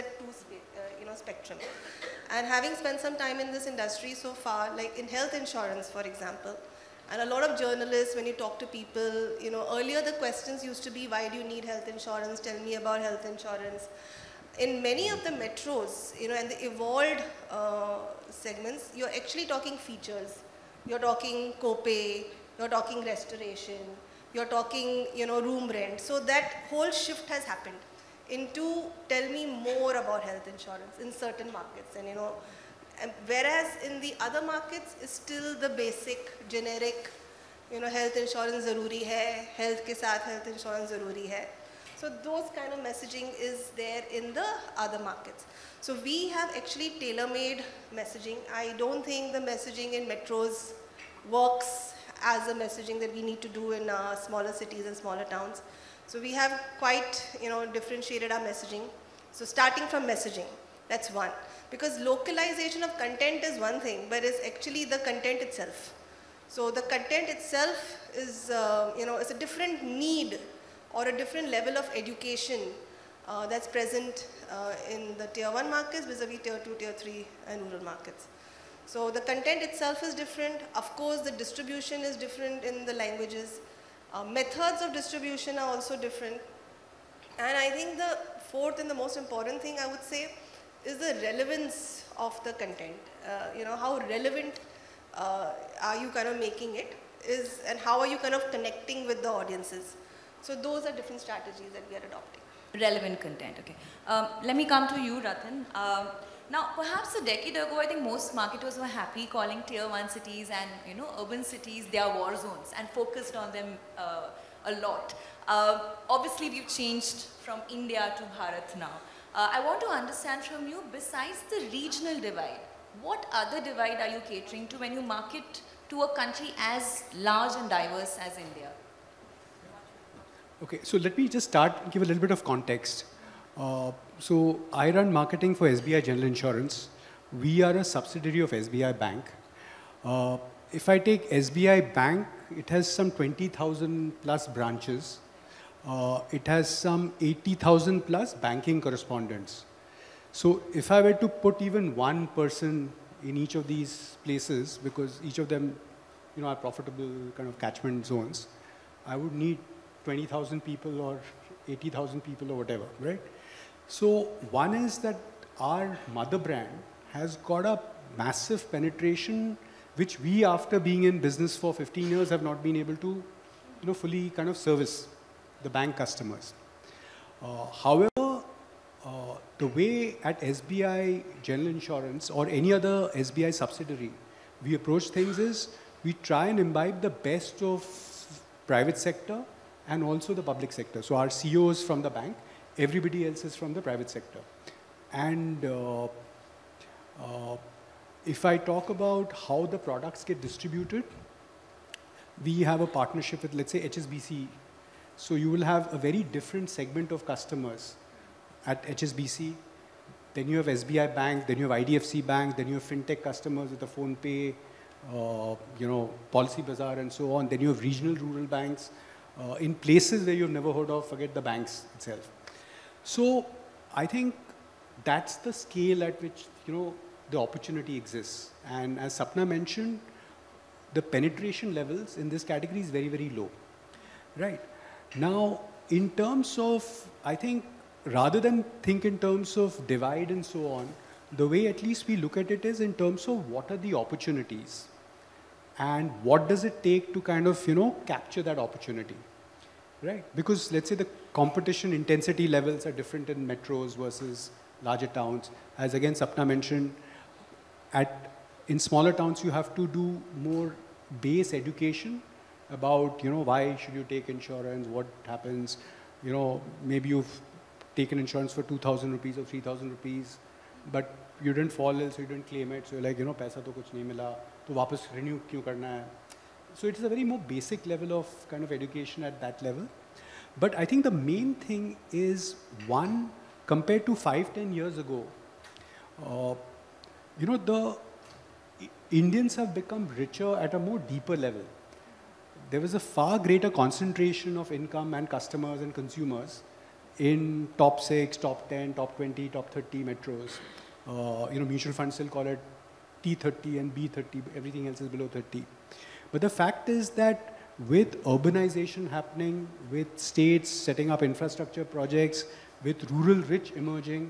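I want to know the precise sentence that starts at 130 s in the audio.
Okay, so let me just start, give a little bit of context.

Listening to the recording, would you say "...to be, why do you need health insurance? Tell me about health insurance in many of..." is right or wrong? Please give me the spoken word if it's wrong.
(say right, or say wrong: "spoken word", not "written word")
right.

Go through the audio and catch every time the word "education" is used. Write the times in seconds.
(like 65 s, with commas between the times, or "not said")
71 s, 261 s, 278 s.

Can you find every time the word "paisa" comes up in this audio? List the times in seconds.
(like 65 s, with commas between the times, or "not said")
273 s.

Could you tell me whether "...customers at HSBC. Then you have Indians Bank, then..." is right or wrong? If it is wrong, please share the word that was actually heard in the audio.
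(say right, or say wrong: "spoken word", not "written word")
wrong: "SBI", not "Indians".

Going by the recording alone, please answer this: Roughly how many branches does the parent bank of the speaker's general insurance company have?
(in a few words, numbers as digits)
20,000.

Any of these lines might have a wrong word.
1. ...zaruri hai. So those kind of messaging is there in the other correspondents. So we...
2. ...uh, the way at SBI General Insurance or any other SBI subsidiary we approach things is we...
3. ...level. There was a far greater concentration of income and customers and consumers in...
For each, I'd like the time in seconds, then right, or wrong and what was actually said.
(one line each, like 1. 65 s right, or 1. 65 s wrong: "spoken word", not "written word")
1. 40 s wrong: "markets", not "correspondents"
2. 179 s right
3. 291 s right.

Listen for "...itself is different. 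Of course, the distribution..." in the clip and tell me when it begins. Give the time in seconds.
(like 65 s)
79 s.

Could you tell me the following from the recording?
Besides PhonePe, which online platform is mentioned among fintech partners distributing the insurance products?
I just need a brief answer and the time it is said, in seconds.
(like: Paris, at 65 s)
Policy Bazaar, at 216 s.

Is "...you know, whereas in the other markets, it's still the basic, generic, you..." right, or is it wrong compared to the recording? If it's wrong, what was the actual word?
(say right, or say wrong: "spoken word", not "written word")
right.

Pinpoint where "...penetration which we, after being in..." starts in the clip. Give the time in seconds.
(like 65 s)
168 s.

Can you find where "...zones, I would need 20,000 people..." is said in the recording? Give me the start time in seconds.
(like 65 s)
158 s.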